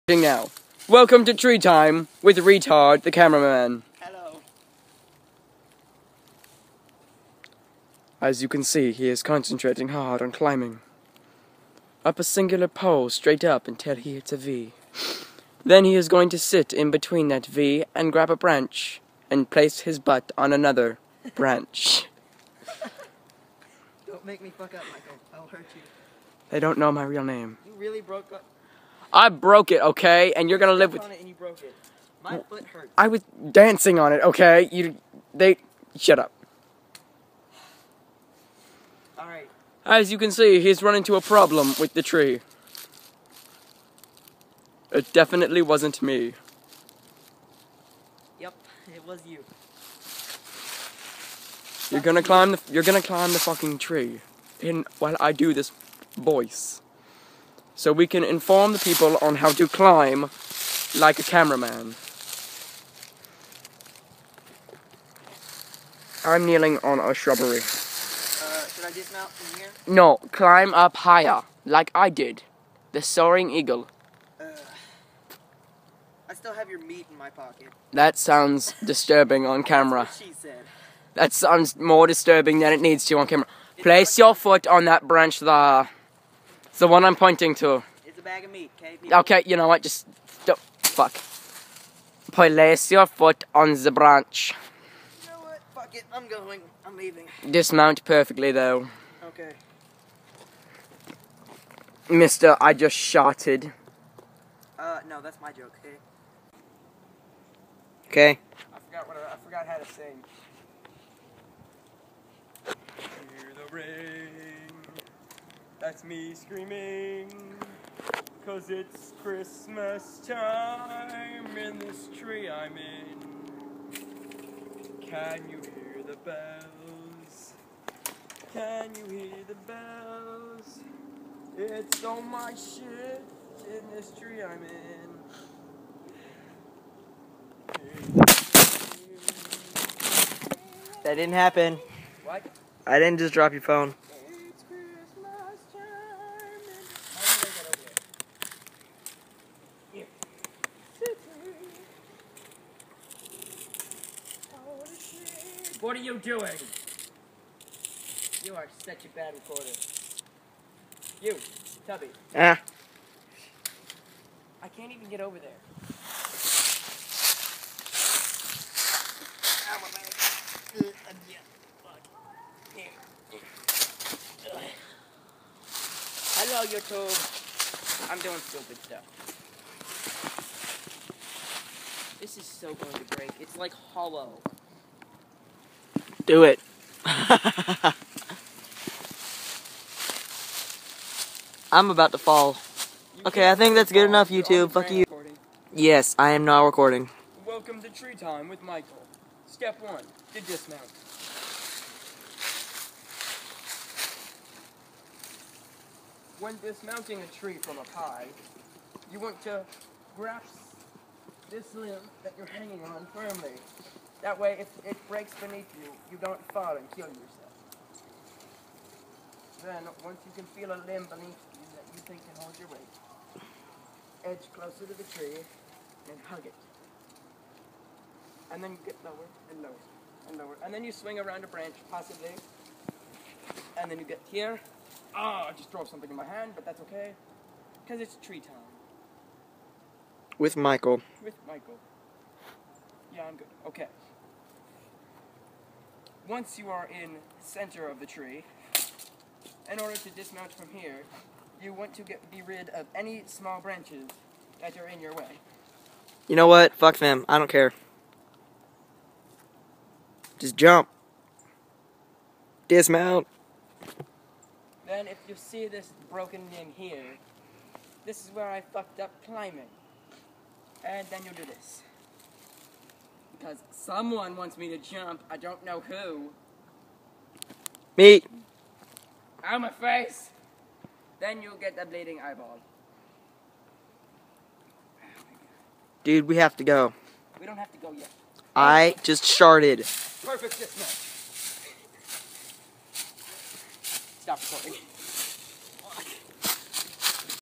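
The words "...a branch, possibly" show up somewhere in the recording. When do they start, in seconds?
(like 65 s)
231 s.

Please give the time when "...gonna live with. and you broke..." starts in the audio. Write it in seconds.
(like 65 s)
30 s.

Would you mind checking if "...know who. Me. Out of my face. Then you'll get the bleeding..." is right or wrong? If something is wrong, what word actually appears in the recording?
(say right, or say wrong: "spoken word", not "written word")
right.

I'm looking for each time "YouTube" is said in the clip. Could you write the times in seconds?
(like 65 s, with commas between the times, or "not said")
176 s, 194 s.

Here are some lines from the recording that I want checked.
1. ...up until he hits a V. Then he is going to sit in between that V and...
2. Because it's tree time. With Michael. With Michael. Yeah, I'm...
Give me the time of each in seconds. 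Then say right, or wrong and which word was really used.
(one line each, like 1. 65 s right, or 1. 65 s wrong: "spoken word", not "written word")
1. 13 s right
2. 237 s right.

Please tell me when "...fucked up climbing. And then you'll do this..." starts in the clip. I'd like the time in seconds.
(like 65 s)
268 s.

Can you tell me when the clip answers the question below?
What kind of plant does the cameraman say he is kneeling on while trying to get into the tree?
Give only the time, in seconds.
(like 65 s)
67 s.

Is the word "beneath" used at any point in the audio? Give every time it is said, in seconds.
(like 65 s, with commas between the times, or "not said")
215 s, 221 s.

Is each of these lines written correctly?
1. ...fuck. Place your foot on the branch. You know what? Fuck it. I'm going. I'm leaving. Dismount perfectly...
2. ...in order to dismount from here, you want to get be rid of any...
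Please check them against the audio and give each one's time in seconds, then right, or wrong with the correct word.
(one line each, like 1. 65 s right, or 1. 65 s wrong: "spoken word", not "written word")
1. 90 s right
2. 249 s right.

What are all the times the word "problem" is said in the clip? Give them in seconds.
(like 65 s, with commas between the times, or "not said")
41 s.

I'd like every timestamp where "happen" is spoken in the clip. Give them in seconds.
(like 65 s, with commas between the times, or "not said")
141 s.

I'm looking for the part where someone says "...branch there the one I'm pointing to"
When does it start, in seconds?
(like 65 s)
85 s.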